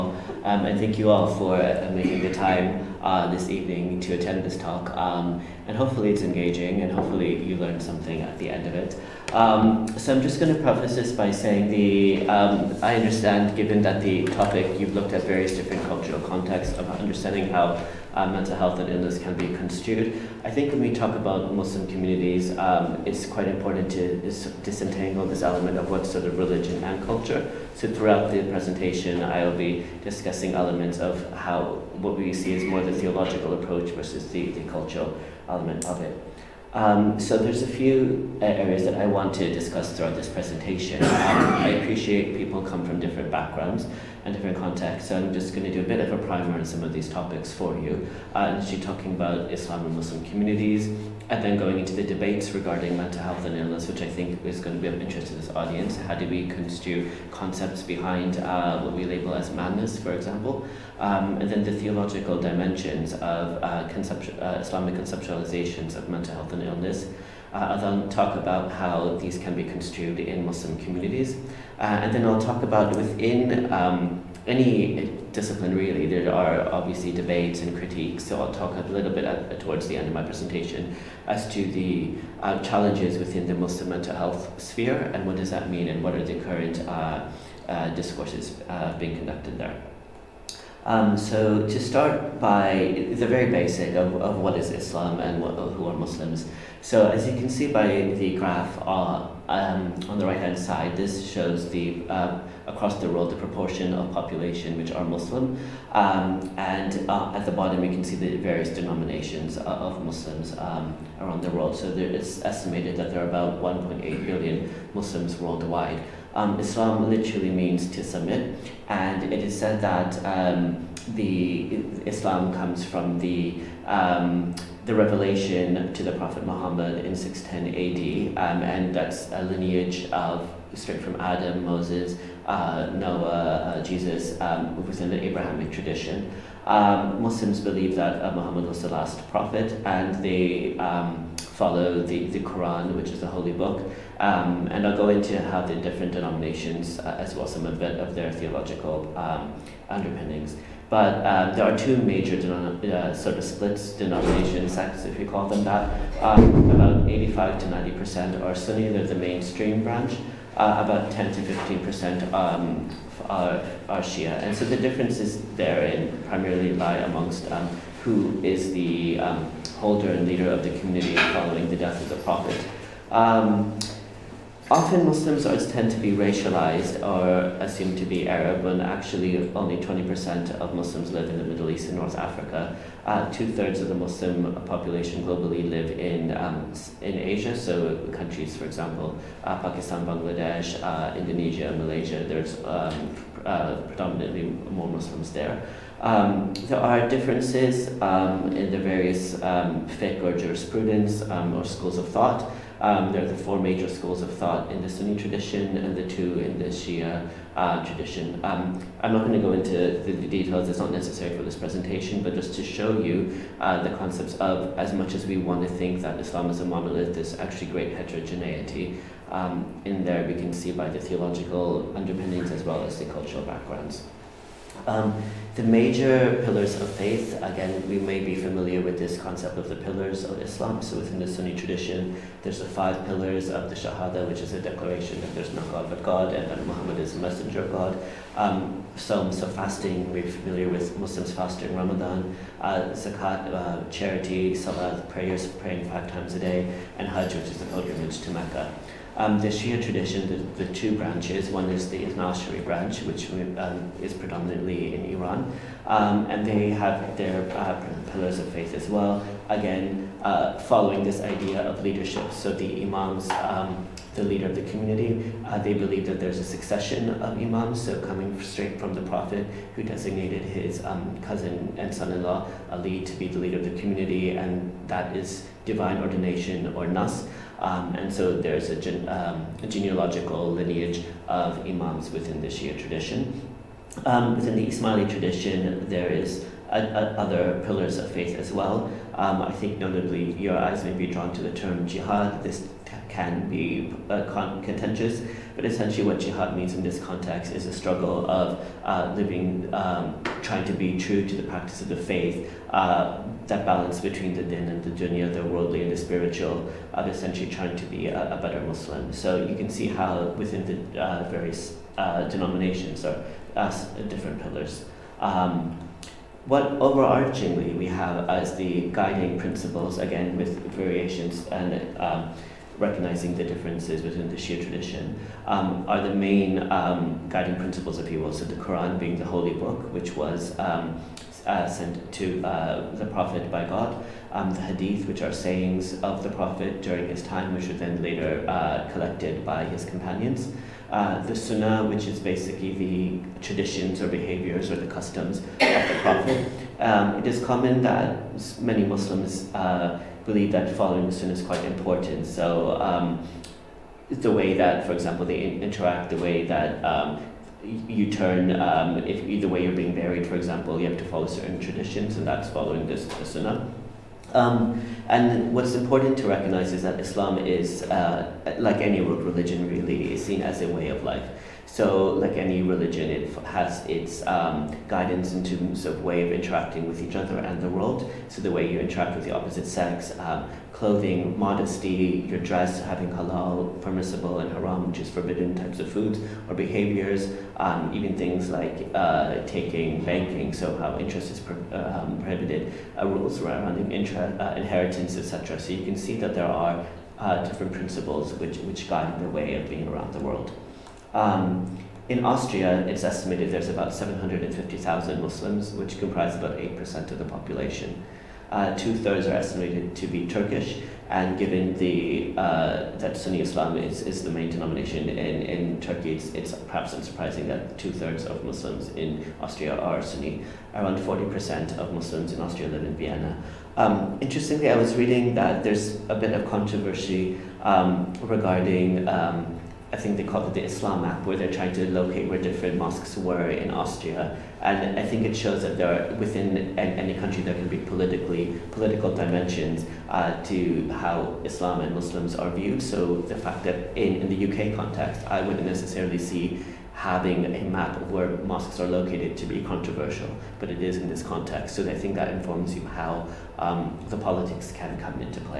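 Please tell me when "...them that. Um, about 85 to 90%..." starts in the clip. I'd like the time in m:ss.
2:35.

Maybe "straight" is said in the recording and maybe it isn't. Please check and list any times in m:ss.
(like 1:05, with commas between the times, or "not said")
2:10, 4:28.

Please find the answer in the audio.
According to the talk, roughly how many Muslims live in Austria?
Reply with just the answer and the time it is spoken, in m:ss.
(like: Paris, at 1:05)
750,000, at 6:43.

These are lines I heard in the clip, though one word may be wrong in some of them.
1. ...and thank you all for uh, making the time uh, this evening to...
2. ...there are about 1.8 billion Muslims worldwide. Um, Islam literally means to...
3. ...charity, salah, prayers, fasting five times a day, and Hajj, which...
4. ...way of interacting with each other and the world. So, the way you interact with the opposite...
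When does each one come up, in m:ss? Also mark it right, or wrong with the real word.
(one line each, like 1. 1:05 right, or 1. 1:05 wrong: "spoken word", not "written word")
1. 0:00 right
2. 1:53 right
3. 4:03 wrong: "praying", not "fasting"
4. 6:16 right.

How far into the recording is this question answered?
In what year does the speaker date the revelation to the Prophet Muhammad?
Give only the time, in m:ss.
2:07.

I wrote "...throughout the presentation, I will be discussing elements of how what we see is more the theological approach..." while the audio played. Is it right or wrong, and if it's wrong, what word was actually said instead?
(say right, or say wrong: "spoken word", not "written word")
right.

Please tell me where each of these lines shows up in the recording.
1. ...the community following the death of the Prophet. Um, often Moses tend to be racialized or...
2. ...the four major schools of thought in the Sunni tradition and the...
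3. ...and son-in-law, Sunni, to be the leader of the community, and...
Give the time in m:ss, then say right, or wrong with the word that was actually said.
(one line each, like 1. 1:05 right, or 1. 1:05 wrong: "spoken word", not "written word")
1. 2:50 wrong: "Muslims", not "Moses"
2. 3:23 right
3. 4:31 wrong: "Ali", not "Sunni".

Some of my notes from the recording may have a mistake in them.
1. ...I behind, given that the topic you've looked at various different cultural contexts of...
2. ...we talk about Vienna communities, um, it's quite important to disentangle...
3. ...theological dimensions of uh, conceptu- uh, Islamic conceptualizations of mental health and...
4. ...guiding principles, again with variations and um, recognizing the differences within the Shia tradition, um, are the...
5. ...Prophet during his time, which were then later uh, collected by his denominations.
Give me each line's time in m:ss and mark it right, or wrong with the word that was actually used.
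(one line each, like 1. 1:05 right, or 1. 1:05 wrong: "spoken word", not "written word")
1. 0:12 wrong: "understand", not "behind"
2. 0:20 wrong: "Muslim", not "Vienna"
3. 1:01 right
4. 5:18 right
5. 5:36 wrong: "companions", not "denominations".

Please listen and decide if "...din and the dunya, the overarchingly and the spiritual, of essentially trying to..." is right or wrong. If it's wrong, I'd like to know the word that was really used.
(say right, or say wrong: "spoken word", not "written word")
wrong: "worldly", not "overarchingly".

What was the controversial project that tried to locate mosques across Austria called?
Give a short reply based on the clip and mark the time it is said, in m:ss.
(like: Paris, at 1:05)
the Islam map, at 7:10.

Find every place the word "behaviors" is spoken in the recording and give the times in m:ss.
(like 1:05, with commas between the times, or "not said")
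5:44, 6:26.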